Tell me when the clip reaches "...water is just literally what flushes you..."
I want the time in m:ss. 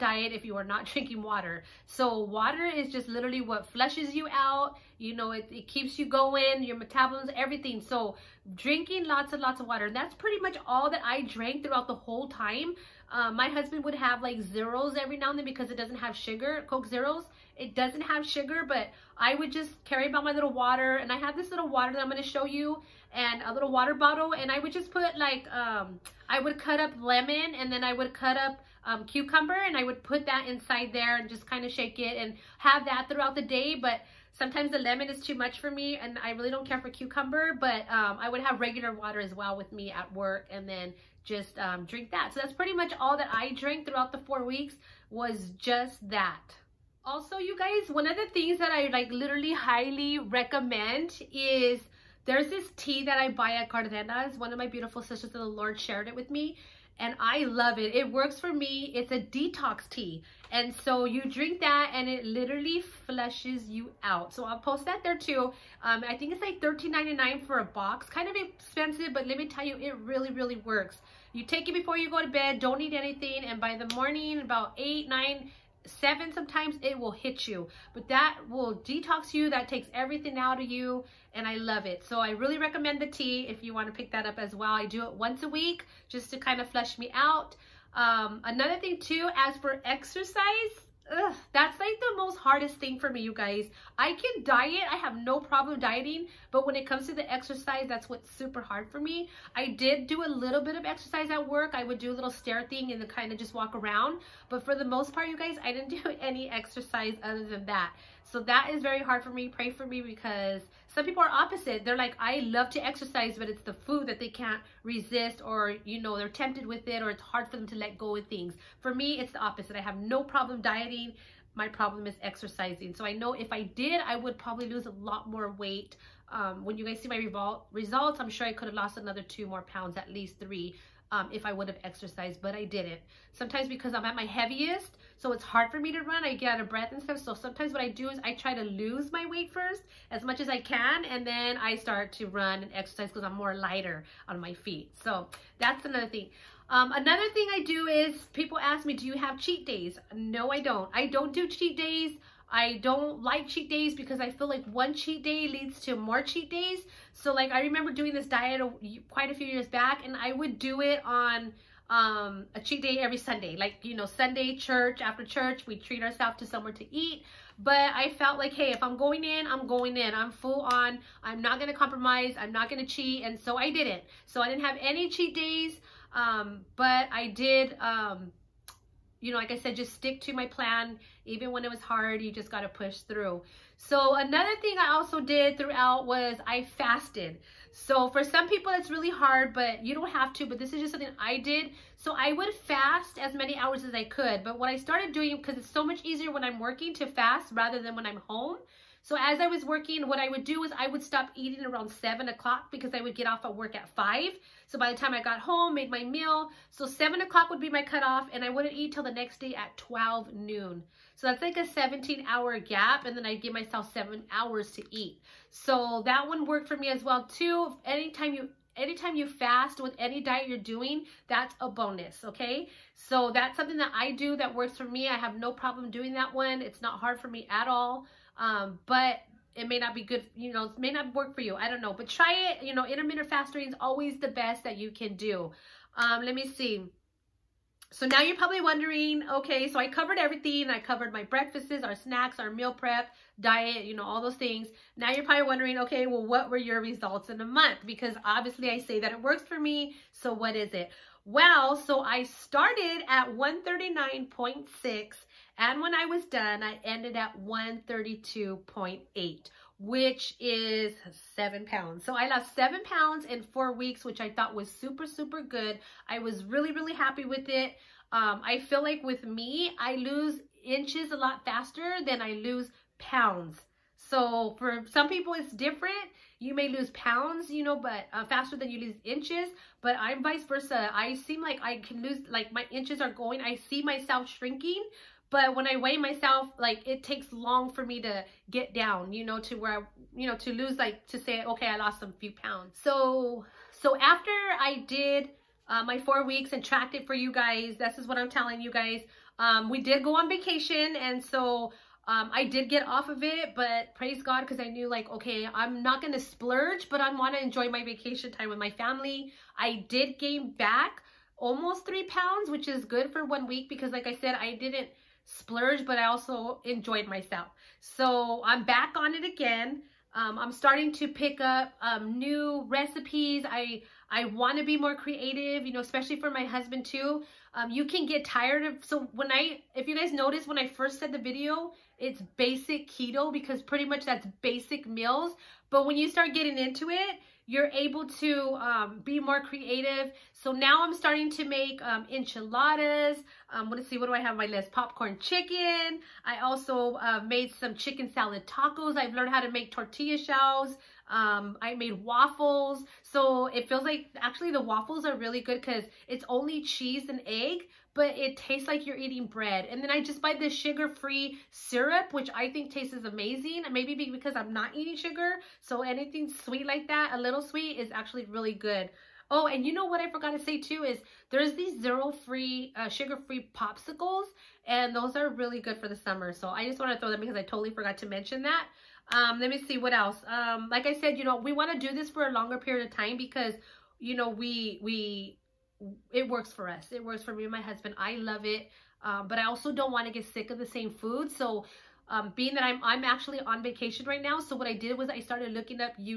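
0:02.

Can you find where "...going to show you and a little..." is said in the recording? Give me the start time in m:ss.
0:22.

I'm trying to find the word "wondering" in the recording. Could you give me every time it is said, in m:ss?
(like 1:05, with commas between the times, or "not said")
3:58, 4:05.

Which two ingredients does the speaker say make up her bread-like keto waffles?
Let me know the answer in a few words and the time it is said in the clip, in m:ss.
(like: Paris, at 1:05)
cheese and egg, at 5:56.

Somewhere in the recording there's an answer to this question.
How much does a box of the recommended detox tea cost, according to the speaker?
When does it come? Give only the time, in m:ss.
1:06.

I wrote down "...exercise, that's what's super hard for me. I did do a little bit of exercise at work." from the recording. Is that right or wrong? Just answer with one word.
right.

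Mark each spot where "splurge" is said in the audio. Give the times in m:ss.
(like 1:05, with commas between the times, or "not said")
5:06, 5:15.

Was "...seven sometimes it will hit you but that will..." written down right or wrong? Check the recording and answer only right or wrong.
right.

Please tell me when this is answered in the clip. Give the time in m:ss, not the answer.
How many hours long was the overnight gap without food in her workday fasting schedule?
3:31.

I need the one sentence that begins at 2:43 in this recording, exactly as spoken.
Like, you know, Sunday church, after church, we treat ourselves to somewhere to eat.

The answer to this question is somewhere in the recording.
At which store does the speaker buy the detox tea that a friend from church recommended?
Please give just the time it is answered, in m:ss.
0:53.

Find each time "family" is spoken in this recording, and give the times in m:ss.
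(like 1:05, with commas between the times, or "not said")
5:08.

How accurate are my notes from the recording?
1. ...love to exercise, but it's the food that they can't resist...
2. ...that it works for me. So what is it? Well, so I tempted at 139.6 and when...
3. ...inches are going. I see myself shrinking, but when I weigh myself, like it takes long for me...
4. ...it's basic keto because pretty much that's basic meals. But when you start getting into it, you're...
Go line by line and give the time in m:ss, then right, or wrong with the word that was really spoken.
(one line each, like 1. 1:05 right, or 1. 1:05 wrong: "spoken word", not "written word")
1. 1:52 right
2. 4:08 wrong: "started", not "tempted"
3. 4:42 right
4. 5:31 right.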